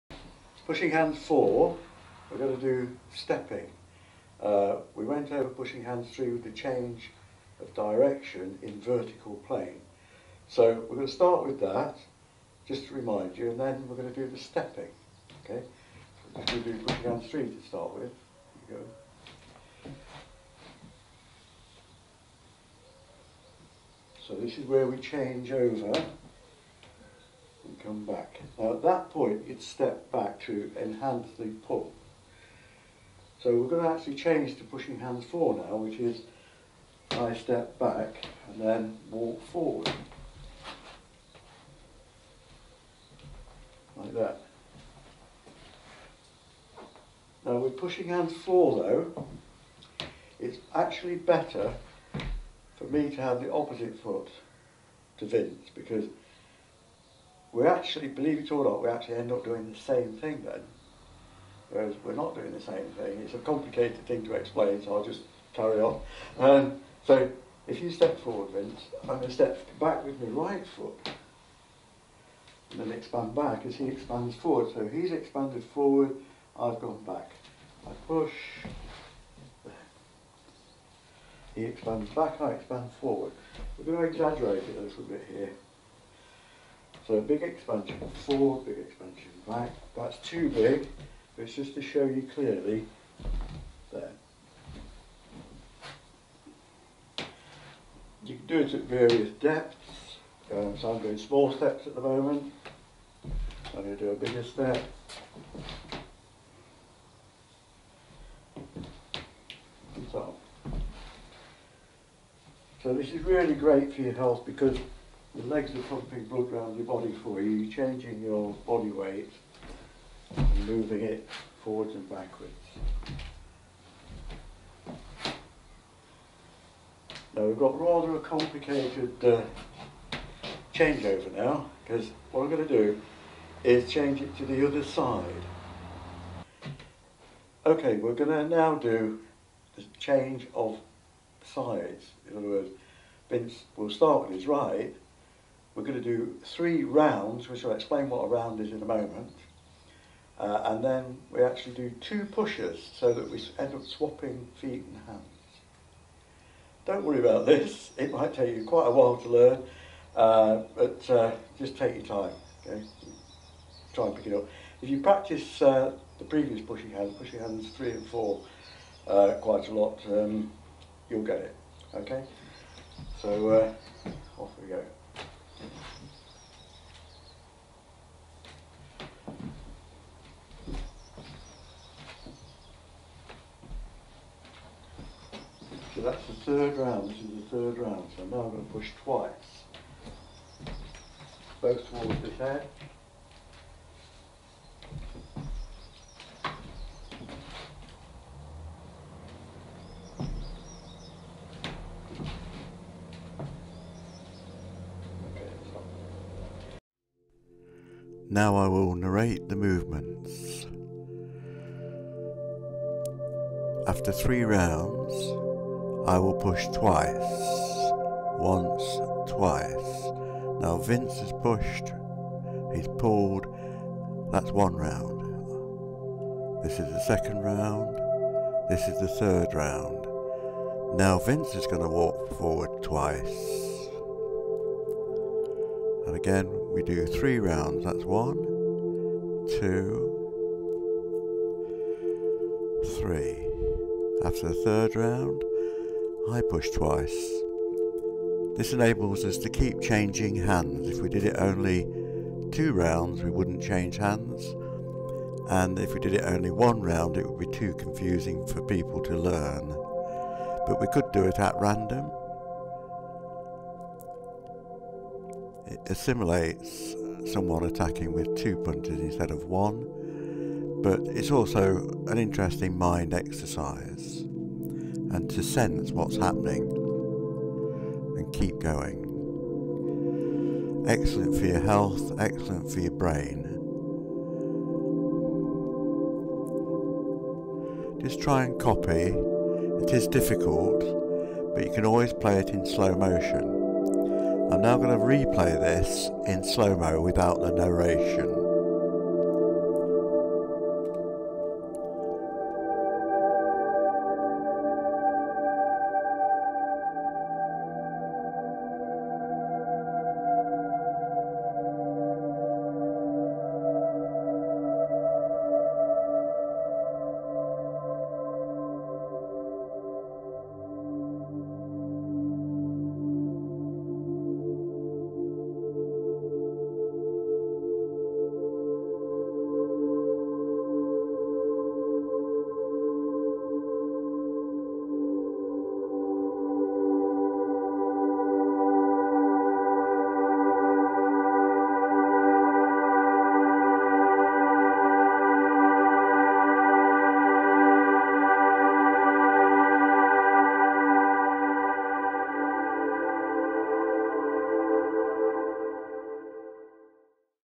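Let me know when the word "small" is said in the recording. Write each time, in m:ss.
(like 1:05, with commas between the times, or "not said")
1:41.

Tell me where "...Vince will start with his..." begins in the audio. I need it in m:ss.
2:23.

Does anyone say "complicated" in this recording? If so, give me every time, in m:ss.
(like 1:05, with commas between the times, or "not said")
1:03, 2:08.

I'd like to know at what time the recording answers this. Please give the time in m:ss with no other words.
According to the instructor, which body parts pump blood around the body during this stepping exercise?
1:55.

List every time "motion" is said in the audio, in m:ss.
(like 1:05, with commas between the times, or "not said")
4:52.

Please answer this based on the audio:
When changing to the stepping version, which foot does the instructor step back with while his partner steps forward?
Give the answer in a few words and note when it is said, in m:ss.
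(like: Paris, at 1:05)
Right foot, at 1:10.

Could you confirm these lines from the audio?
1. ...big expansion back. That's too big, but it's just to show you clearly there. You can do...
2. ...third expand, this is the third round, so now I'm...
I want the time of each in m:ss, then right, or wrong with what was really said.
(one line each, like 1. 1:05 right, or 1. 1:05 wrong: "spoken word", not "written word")
1. 1:28 right
2. 3:06 wrong: "round", not "expand".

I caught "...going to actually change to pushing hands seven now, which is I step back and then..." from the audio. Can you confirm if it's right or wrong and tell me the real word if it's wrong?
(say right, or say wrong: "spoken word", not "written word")
wrong: "four", not "seven".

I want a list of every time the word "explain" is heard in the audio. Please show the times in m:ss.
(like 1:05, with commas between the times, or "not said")
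1:04, 2:27.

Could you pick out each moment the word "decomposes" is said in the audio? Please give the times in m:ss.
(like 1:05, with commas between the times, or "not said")
not said.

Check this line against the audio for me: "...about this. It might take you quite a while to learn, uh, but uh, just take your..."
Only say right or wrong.
right.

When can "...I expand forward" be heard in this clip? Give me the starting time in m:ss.
1:22.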